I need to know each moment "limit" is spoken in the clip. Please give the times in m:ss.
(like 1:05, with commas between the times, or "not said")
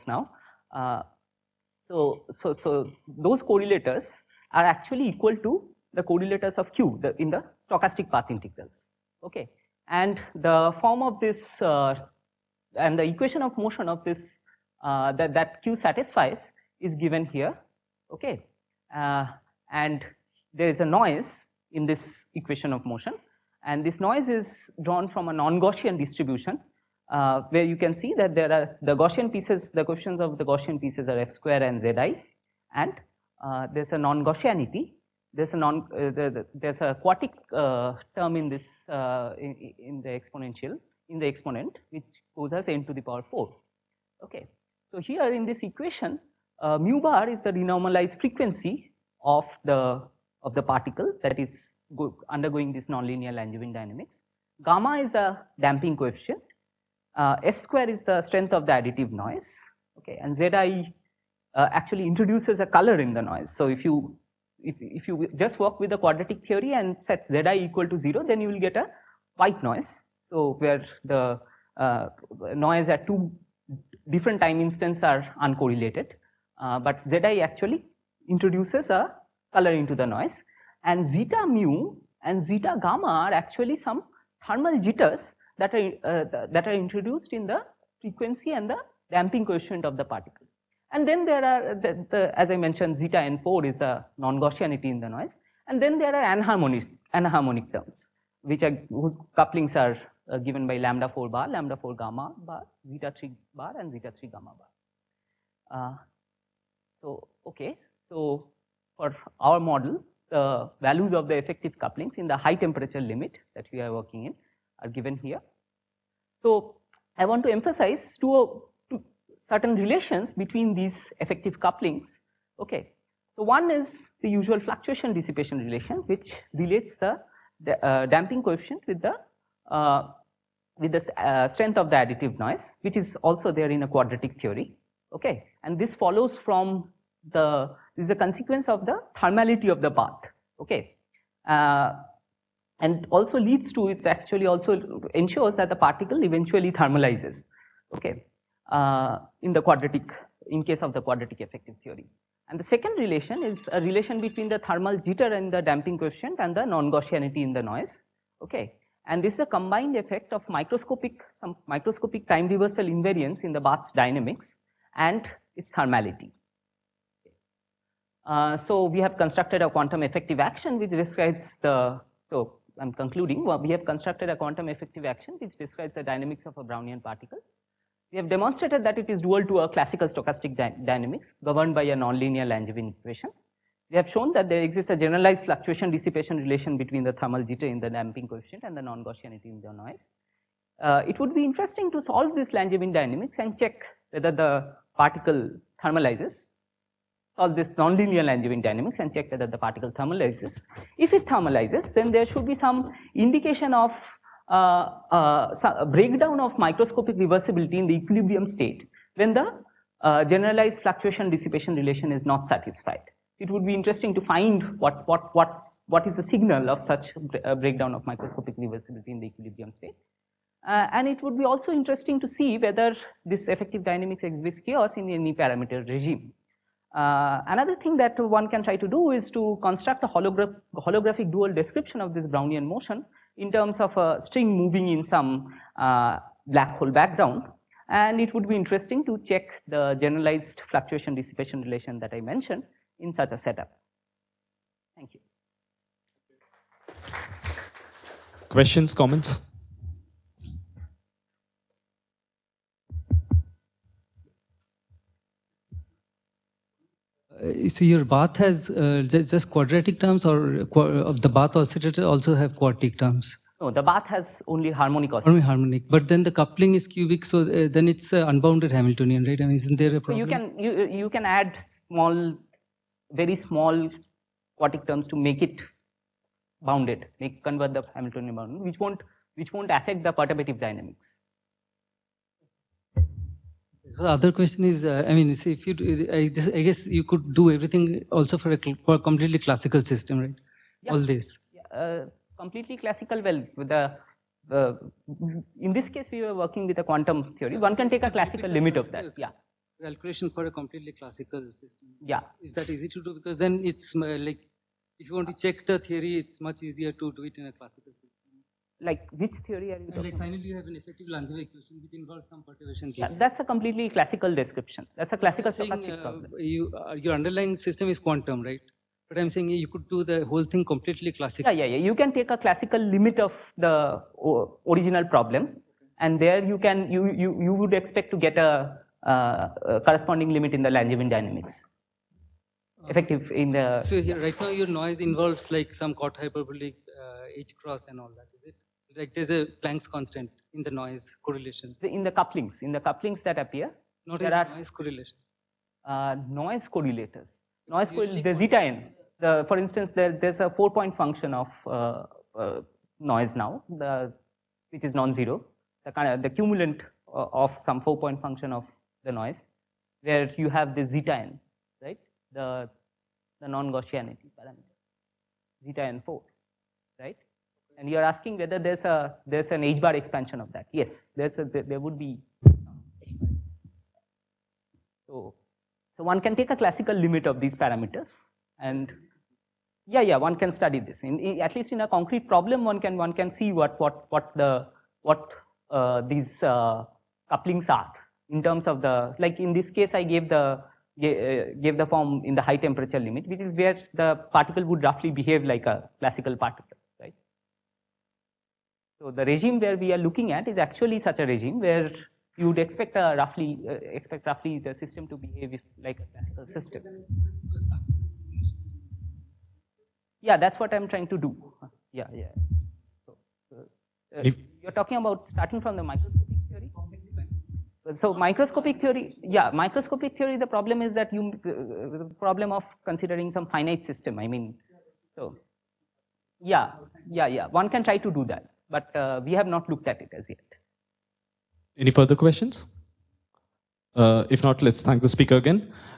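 1:53, 4:58, 5:22, 5:30, 6:16, 6:33.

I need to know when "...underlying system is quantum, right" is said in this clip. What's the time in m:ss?
5:17.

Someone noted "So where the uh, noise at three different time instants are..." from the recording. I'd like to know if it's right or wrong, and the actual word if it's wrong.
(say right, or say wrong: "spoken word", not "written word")
wrong: "two", not "three".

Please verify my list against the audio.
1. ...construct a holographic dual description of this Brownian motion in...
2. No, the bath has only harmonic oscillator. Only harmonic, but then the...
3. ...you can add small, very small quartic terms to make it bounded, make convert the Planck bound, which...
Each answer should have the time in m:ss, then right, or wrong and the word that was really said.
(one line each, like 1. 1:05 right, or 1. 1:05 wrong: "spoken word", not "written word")
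1. 3:49 right
2. 4:23 right
3. 4:30 wrong: "Hamiltonian", not "Planck".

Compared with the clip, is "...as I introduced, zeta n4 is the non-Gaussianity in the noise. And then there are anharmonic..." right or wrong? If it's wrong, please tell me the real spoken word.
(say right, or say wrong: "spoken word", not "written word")
wrong: "mentioned", not "introduced".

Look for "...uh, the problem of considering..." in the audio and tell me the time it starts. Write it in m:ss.
7:01.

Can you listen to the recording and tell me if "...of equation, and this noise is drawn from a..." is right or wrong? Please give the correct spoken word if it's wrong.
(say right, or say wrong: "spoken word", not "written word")
wrong: "motion", not "equation".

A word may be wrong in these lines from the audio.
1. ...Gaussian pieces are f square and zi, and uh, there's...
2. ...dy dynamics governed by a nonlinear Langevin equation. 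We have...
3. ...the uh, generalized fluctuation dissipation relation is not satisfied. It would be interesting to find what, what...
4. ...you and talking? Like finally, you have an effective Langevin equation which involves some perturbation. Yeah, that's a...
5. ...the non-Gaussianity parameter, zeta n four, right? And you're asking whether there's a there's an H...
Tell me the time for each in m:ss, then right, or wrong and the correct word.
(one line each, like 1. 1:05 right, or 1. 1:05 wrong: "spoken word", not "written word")
1. 0:30 right
2. 3:00 right
3. 3:29 right
4. 5:09 right
5. 6:03 right.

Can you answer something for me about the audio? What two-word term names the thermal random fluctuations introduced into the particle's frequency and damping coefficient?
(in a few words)
thermal jitters.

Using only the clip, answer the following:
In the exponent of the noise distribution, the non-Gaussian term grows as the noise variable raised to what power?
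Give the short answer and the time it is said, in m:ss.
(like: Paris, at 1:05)
4, at 0:42.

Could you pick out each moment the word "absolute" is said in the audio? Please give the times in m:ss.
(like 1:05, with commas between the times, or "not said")
not said.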